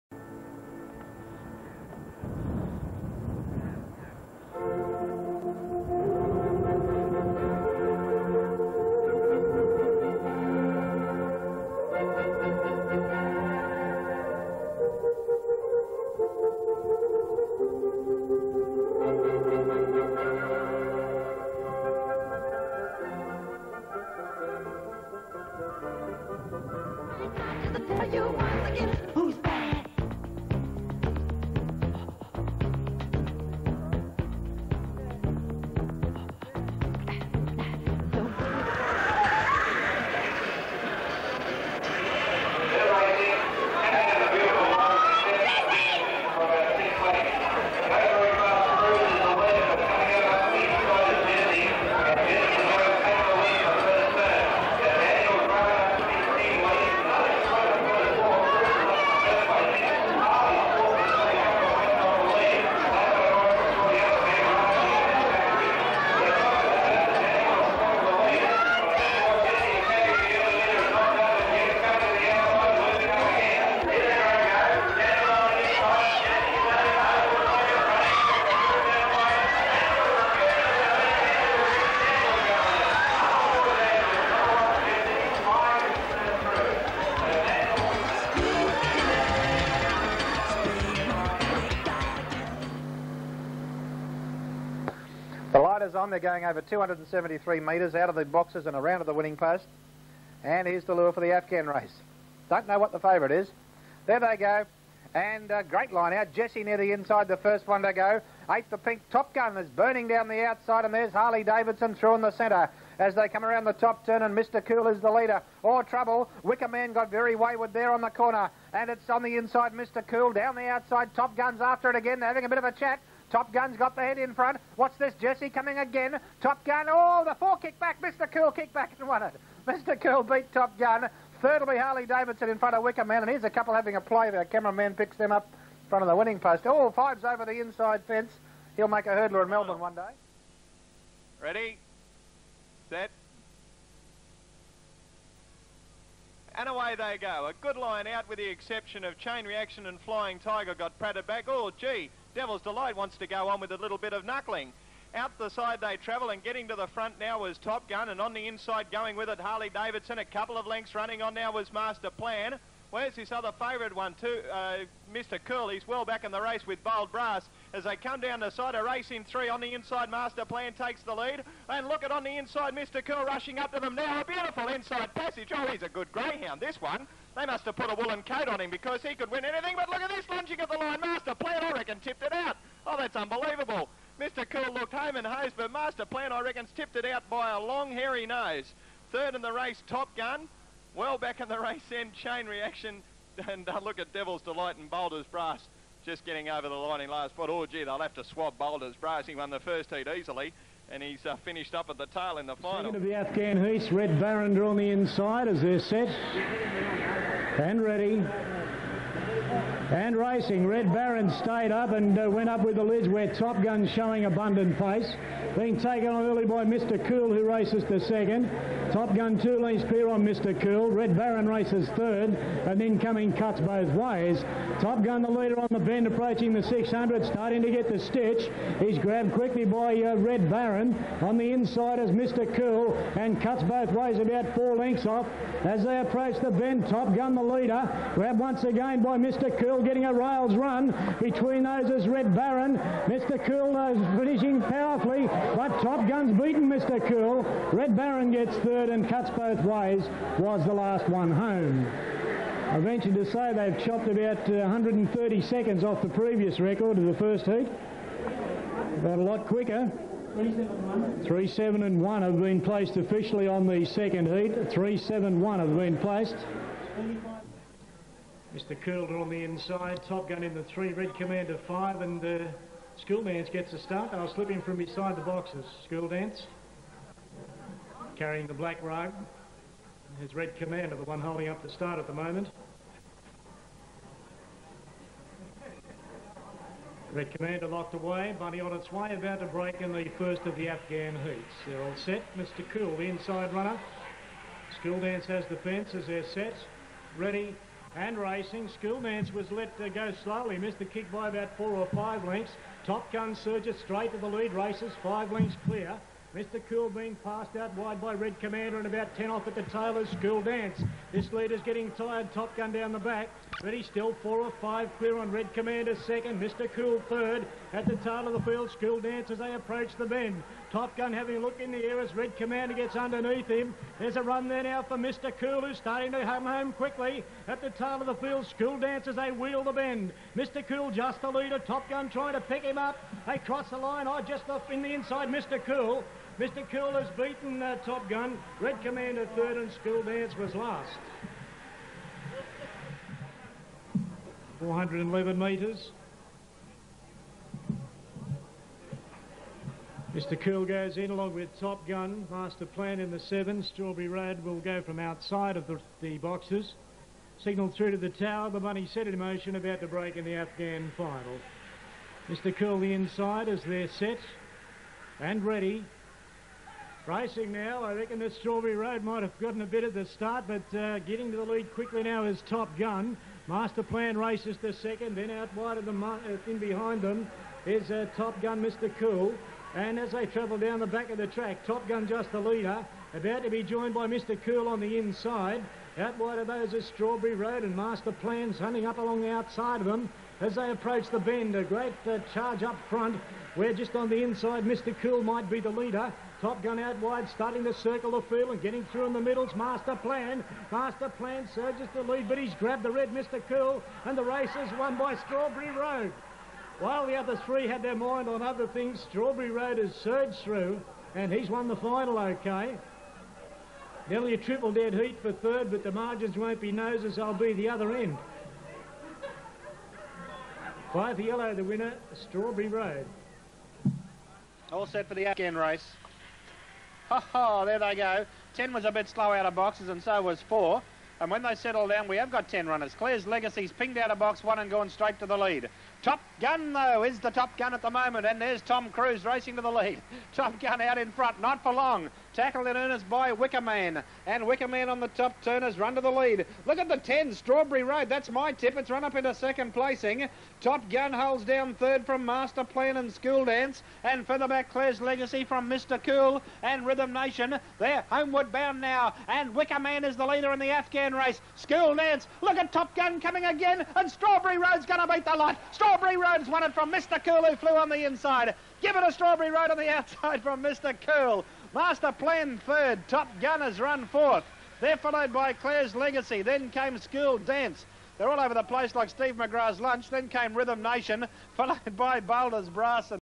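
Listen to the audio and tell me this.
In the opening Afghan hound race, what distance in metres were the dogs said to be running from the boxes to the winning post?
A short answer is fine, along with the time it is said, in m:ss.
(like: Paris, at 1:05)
273 metres, at 1:36.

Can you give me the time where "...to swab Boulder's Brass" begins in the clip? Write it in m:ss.
3:18.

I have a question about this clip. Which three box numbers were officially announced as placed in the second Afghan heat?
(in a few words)
3-7-1.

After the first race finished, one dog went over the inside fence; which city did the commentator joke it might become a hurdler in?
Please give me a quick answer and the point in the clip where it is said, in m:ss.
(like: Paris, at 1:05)
Melbourne, at 2:19.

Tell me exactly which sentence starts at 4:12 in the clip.
I venture to say they've chopped about 130 uh, seconds off the previous record of the first heat.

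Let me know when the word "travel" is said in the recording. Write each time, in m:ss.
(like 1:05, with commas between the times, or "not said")
2:35, 6:20.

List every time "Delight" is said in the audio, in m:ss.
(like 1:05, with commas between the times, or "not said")
2:32, 3:14.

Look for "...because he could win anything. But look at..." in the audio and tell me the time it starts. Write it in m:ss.
2:58.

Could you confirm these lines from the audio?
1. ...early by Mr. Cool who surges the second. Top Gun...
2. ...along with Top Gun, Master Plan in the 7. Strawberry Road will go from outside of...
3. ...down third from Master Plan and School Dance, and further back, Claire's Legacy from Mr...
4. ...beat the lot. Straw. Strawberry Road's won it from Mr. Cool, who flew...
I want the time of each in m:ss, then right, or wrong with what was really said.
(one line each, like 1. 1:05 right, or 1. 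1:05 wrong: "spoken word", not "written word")
1. 3:36 wrong: "races", not "surges"
2. 5:51 right
3. 7:31 right
4. 7:45 right.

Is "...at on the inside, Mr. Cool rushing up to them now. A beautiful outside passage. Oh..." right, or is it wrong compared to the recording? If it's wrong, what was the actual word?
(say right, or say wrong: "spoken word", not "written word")
wrong: "inside", not "outside".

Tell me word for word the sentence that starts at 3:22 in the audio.
Second of the Afghan heats, Red Barrinder on the inside as they're set and ready.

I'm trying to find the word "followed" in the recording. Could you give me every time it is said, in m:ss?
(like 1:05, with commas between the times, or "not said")
7:54, 8:01.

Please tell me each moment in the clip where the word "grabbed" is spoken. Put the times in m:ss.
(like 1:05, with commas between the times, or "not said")
3:48, 3:58, 6:42.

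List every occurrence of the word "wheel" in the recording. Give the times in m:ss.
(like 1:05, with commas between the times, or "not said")
5:29.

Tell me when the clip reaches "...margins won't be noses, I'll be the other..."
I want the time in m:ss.
6:55.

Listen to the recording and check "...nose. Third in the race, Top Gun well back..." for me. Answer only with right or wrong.
right.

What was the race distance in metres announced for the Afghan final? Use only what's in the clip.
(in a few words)
411 metres.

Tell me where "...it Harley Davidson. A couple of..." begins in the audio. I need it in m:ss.
2:39.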